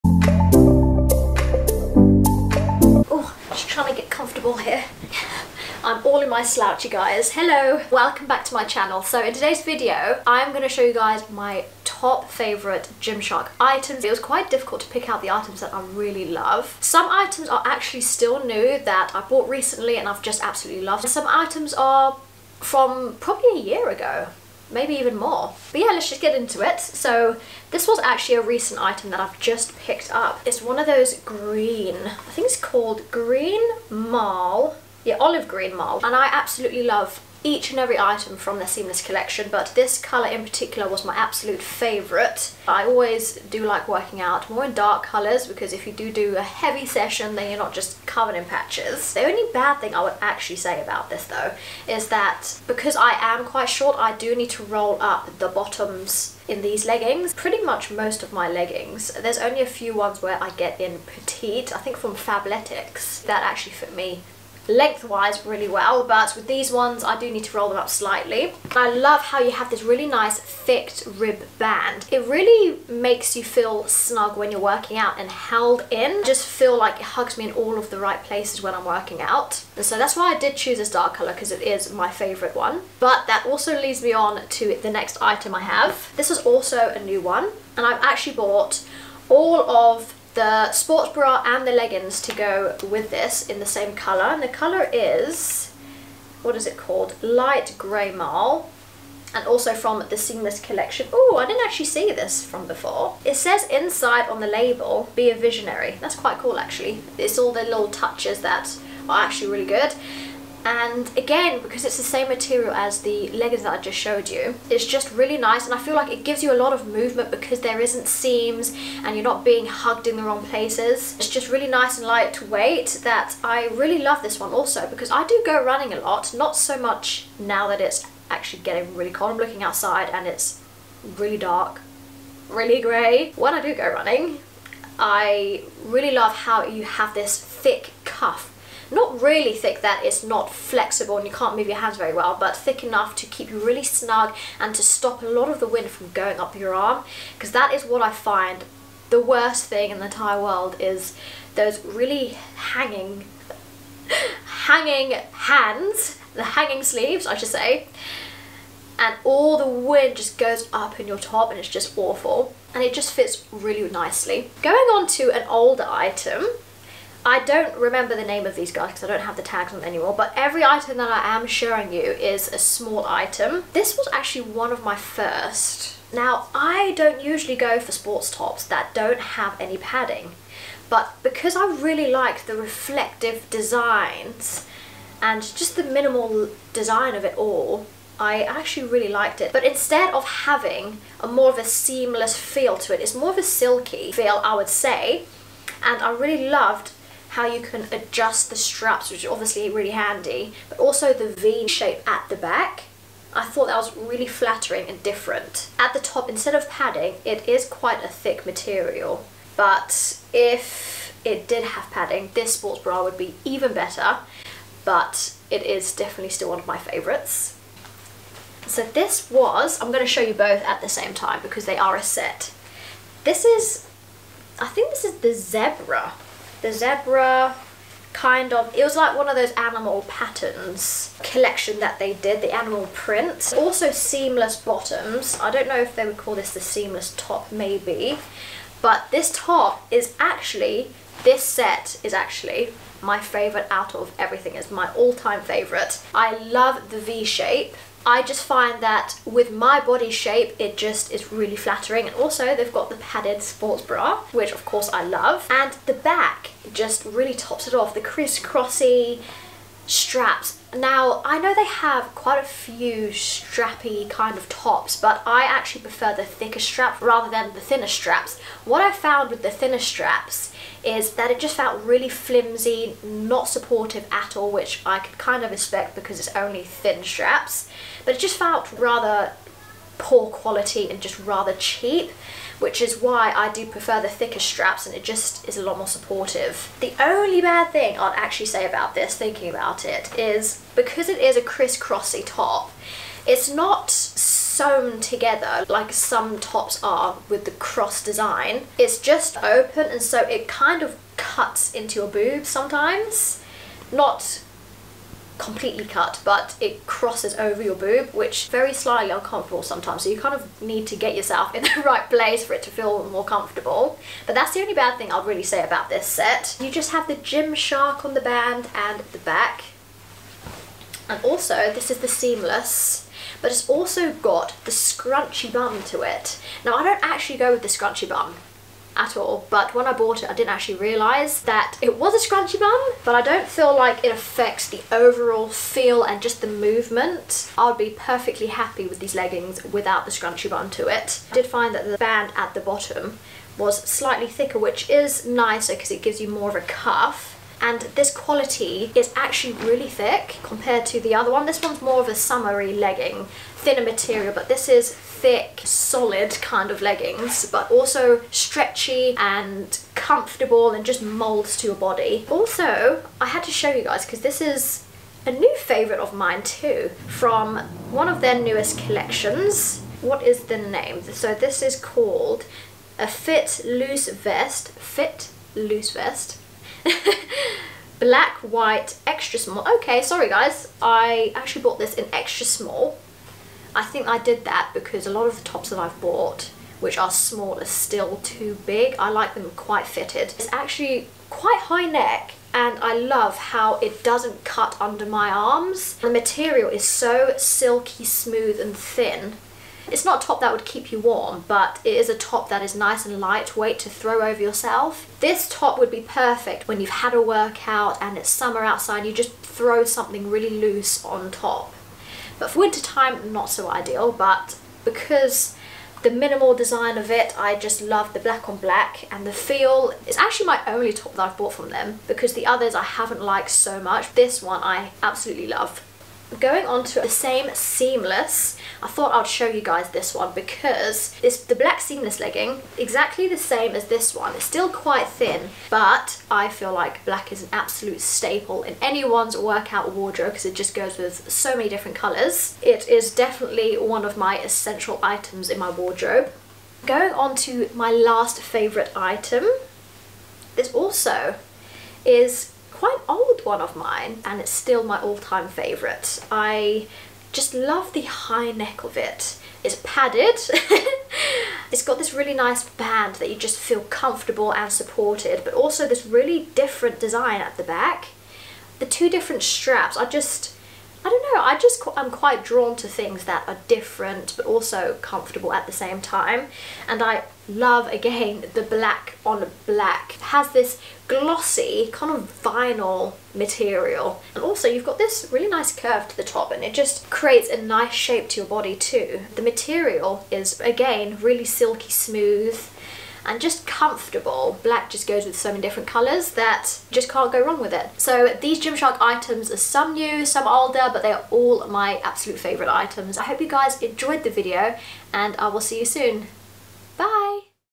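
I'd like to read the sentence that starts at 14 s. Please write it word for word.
It was quite difficult to pick out the items that I really love.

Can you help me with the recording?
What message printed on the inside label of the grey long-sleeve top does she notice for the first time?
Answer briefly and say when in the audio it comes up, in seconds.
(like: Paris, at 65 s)
Be a visionary, at 105 s.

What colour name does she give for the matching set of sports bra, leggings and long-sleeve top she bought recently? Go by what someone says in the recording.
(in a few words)
Light Grey Marl.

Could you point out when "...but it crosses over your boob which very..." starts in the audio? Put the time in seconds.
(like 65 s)
306 s.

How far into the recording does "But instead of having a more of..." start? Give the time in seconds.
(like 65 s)
189 s.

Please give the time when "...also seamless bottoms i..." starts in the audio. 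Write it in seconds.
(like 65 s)
233 s.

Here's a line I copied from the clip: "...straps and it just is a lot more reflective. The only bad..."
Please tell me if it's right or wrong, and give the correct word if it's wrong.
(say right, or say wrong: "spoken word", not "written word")
wrong: "supportive", not "reflective".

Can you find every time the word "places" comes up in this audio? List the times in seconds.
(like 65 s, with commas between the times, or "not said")
78 s, 120 s, 312 s.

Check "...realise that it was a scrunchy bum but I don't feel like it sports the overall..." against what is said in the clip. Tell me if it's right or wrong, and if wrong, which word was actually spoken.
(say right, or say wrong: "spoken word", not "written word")
wrong: "affects", not "sports".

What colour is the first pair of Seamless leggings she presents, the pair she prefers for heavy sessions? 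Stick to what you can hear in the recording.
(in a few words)
Olive green marl.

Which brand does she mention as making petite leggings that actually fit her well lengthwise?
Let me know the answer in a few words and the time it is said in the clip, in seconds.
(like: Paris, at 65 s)
Fabletics, at 62 s.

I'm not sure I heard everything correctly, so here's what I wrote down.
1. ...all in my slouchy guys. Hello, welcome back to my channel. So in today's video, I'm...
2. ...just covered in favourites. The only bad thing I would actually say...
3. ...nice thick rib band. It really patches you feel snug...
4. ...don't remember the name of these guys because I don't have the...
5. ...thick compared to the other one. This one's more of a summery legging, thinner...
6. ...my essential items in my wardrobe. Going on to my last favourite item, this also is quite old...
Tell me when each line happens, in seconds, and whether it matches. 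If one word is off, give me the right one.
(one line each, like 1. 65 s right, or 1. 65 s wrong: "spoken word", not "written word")
1. 6 s right
2. 47 s wrong: "patches", not "favourites"
3. 70 s wrong: "makes", not "patches"
4. 167 s right
5. 349 s right
6. 444 s right.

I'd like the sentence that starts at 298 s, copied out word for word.
It's just open and so it kind of cuts into your boobs sometimes.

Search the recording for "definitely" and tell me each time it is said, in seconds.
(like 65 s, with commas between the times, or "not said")
215 s, 443 s.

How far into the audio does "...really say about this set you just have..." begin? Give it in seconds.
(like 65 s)
315 s.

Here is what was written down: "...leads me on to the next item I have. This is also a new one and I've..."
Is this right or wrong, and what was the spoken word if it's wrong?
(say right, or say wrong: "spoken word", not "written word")
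right.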